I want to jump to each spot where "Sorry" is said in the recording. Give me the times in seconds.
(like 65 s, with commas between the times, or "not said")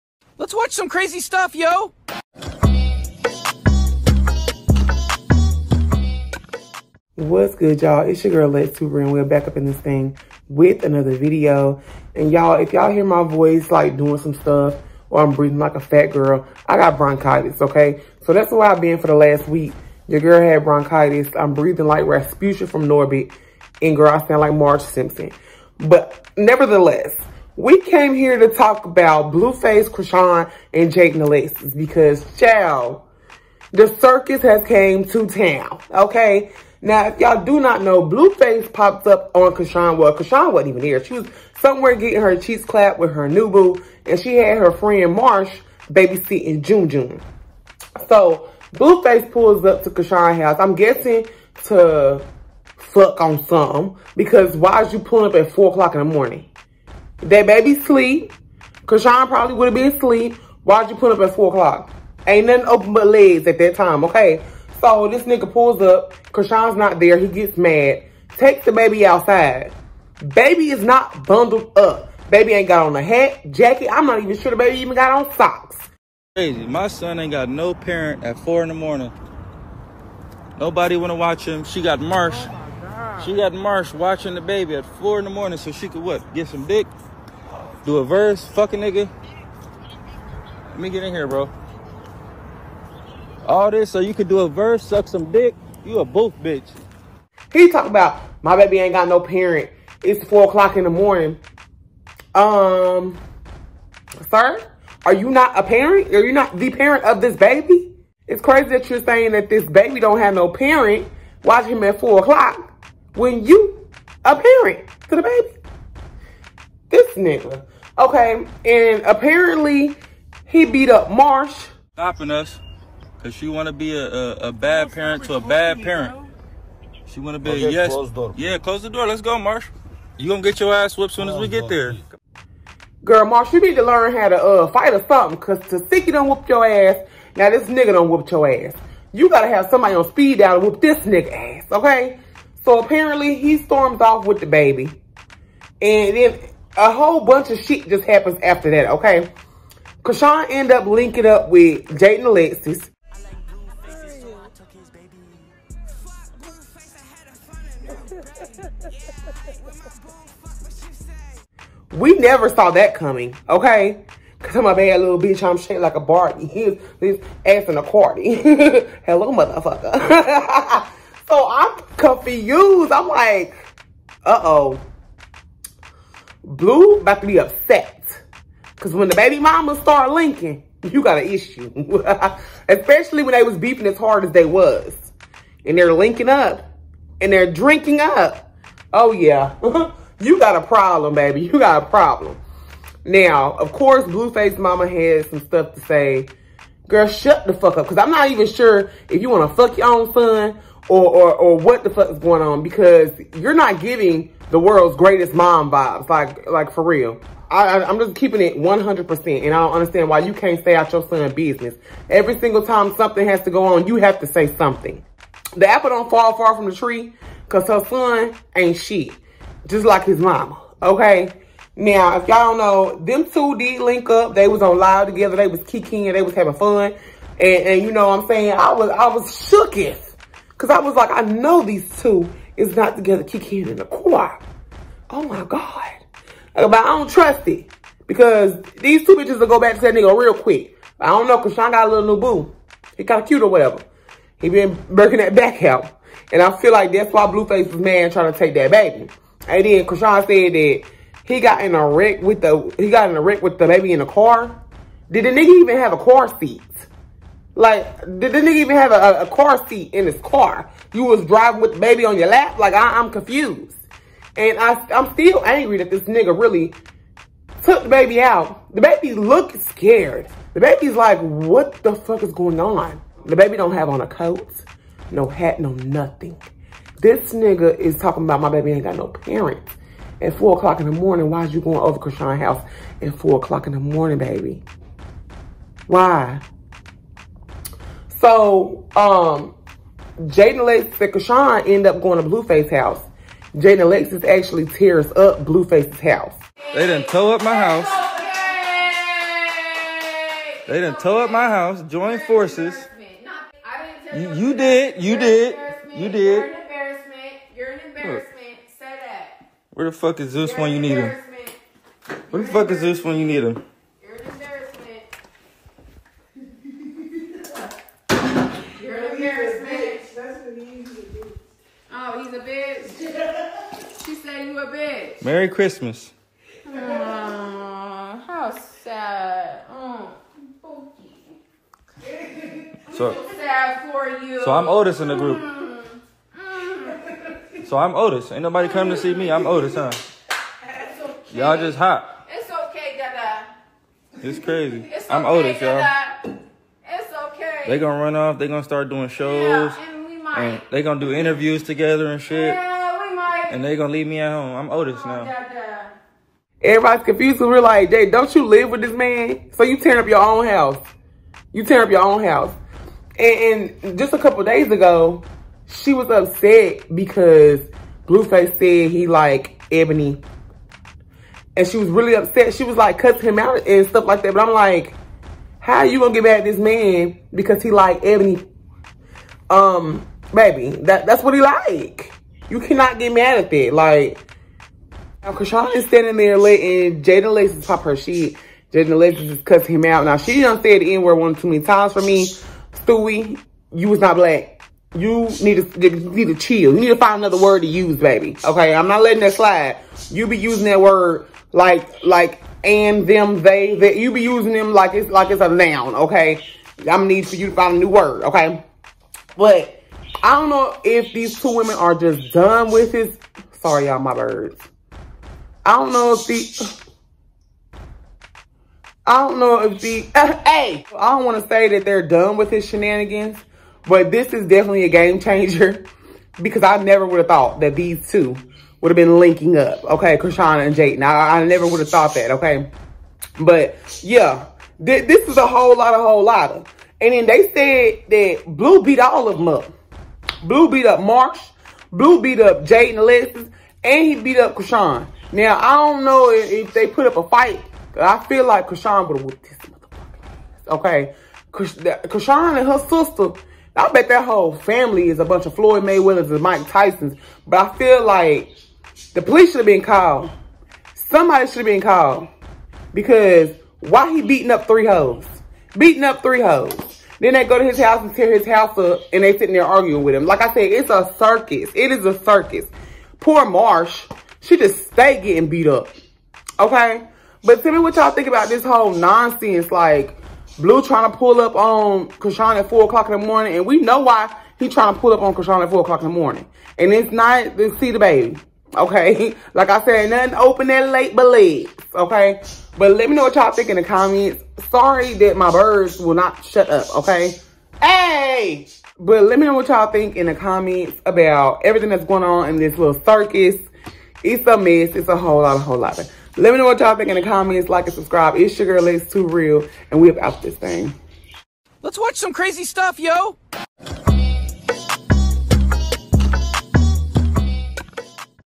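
413 s, 494 s.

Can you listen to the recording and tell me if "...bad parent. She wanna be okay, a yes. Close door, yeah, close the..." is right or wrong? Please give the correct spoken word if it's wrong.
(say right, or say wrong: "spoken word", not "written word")
right.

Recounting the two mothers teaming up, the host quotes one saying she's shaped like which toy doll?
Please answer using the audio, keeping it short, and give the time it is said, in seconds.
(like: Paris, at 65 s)
Barbie, at 165 s.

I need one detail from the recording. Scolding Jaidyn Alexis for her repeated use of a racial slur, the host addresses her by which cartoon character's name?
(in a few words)
Stewie.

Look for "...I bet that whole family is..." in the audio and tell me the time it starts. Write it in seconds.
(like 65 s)
453 s.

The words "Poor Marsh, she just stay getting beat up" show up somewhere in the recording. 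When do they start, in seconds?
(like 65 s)
473 s.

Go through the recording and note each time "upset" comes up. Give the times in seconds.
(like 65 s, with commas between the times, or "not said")
177 s, 366 s, 372 s.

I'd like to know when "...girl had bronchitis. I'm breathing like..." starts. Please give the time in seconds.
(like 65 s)
20 s.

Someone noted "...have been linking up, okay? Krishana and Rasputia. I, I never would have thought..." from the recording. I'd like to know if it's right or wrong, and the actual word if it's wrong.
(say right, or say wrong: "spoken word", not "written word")
wrong: "Jaidyn", not "Rasputia".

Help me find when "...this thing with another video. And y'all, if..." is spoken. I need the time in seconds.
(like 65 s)
9 s.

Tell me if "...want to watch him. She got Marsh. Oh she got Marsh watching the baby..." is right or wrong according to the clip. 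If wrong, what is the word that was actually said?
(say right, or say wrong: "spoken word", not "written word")
right.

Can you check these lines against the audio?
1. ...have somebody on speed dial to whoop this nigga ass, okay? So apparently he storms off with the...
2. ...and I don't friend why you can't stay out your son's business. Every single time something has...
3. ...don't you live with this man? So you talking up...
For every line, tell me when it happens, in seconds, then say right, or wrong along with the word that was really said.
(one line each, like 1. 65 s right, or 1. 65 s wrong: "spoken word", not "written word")
1. 139 s right
2. 209 s wrong: "understand", not "friend"
3. 358 s wrong: "tearing", not "talking".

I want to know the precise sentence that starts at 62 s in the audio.
Ain't nothing open but legs at that time, okay?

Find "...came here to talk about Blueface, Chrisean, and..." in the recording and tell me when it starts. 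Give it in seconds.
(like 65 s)
27 s.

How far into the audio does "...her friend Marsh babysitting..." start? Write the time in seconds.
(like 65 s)
44 s.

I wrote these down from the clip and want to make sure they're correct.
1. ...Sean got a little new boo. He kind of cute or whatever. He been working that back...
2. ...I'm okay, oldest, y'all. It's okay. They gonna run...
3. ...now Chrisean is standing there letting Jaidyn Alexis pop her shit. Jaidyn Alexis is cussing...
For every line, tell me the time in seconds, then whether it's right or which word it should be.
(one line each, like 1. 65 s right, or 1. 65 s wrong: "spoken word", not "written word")
1. 241 s right
2. 345 s right
3. 385 s right.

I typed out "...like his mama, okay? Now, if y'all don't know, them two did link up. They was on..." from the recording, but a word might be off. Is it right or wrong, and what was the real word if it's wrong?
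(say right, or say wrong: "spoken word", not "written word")
right.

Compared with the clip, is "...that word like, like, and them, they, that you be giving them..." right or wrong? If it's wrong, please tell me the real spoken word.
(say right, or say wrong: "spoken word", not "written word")
wrong: "using", not "giving".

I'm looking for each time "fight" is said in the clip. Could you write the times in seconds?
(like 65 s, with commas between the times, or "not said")
134 s, 447 s.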